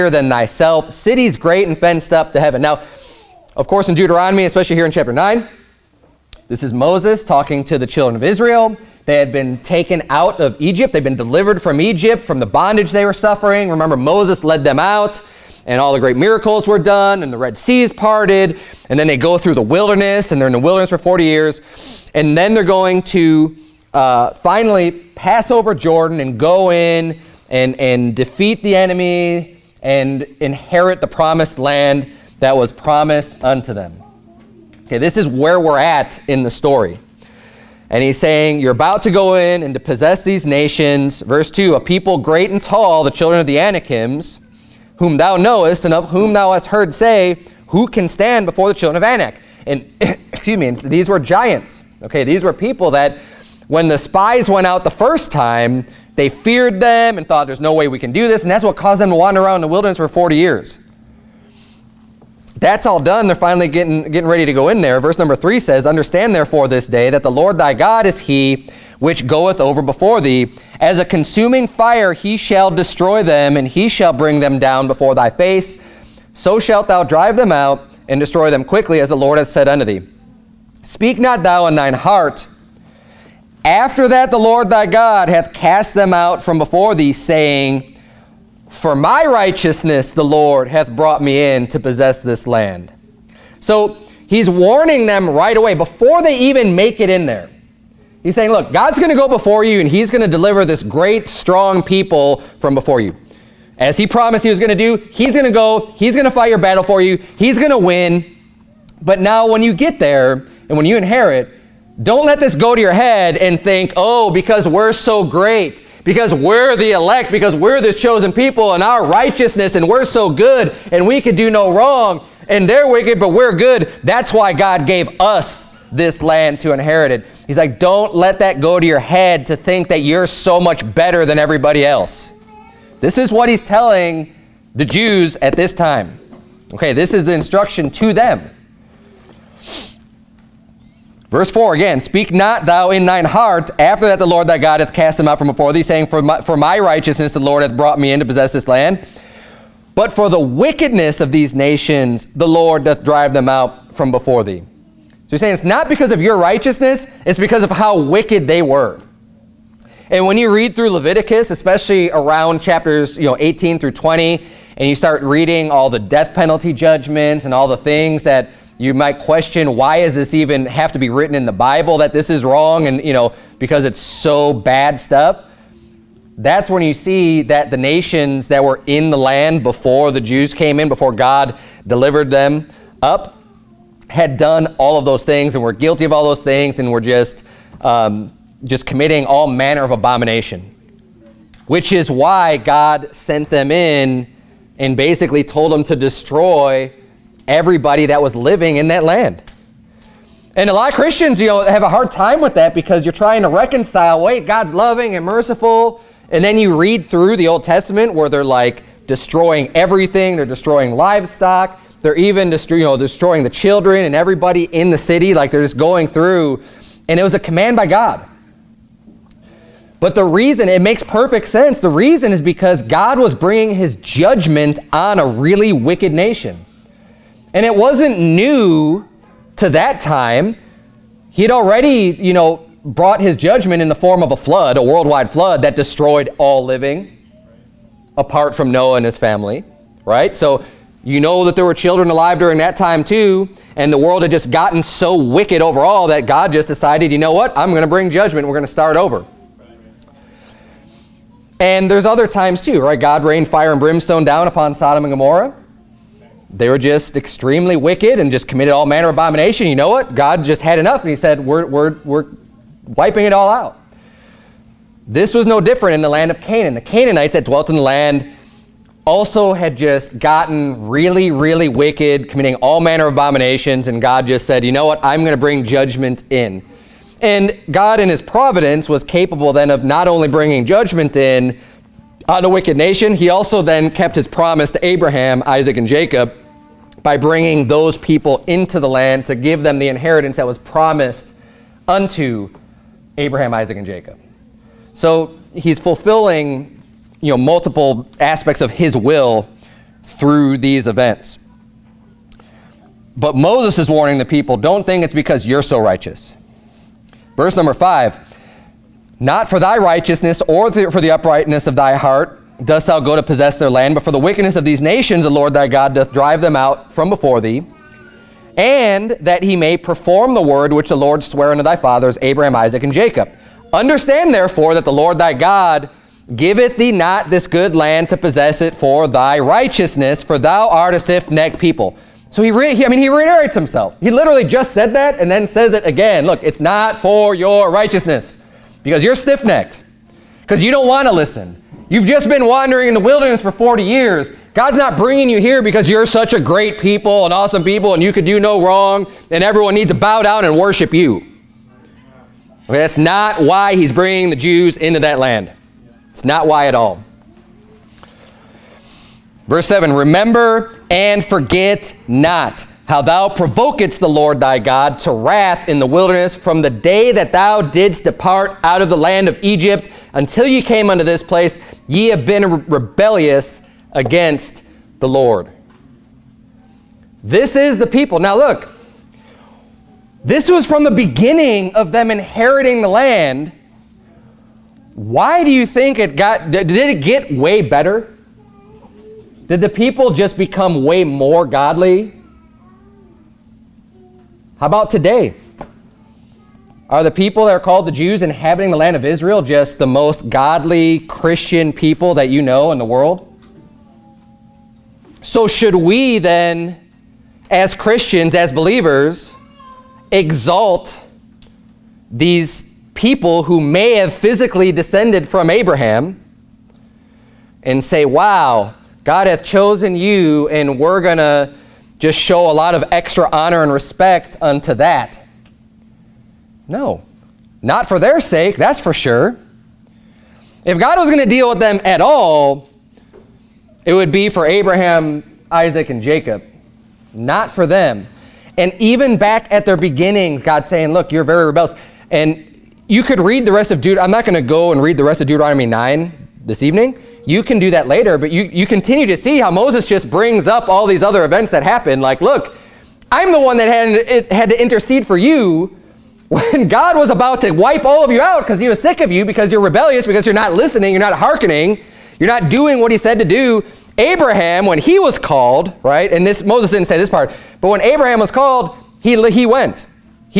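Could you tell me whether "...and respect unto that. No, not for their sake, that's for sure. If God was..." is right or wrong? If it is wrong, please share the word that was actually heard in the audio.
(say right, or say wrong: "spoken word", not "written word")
right.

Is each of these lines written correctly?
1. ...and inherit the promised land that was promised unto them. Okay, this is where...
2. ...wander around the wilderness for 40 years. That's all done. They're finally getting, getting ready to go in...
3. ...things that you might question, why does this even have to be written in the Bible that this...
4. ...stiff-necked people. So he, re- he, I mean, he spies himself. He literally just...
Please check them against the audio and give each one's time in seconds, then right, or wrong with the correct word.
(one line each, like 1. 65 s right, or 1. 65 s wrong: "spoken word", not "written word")
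1. 29 s right
2. 59 s right
3. 167 s right
4. 330 s wrong: "reiterates", not "spies".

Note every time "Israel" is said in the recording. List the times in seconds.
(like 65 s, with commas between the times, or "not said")
8 s, 399 s.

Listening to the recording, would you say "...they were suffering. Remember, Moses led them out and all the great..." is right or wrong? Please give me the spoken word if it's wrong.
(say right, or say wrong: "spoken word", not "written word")
right.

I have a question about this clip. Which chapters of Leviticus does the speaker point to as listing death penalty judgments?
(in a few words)
18 through 20.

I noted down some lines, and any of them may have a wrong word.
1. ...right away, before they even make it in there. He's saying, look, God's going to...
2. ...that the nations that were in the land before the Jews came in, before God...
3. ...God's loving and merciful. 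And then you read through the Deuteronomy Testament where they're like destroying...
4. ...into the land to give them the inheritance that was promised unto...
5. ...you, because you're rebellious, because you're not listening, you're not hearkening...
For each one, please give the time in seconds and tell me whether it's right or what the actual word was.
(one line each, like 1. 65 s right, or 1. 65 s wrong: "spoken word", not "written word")
1. 95 s right
2. 177 s right
3. 204 s wrong: "Old", not "Deuteronomy"
4. 288 s right
5. 459 s right.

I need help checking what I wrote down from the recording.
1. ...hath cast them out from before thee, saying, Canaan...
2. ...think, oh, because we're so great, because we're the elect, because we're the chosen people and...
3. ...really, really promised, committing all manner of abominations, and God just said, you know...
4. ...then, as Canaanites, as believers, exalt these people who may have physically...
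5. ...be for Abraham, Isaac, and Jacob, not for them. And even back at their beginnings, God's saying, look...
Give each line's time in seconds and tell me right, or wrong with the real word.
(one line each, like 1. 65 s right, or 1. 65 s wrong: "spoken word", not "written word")
1. 85 s wrong: "For", not "Canaan"
2. 113 s right
3. 270 s wrong: "wicked", not "promised"
4. 406 s wrong: "Christians", not "Canaanites"
5. 434 s right.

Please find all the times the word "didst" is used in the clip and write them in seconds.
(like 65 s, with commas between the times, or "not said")
367 s.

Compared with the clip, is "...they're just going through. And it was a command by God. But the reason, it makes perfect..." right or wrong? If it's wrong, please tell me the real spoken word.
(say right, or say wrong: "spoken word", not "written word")
right.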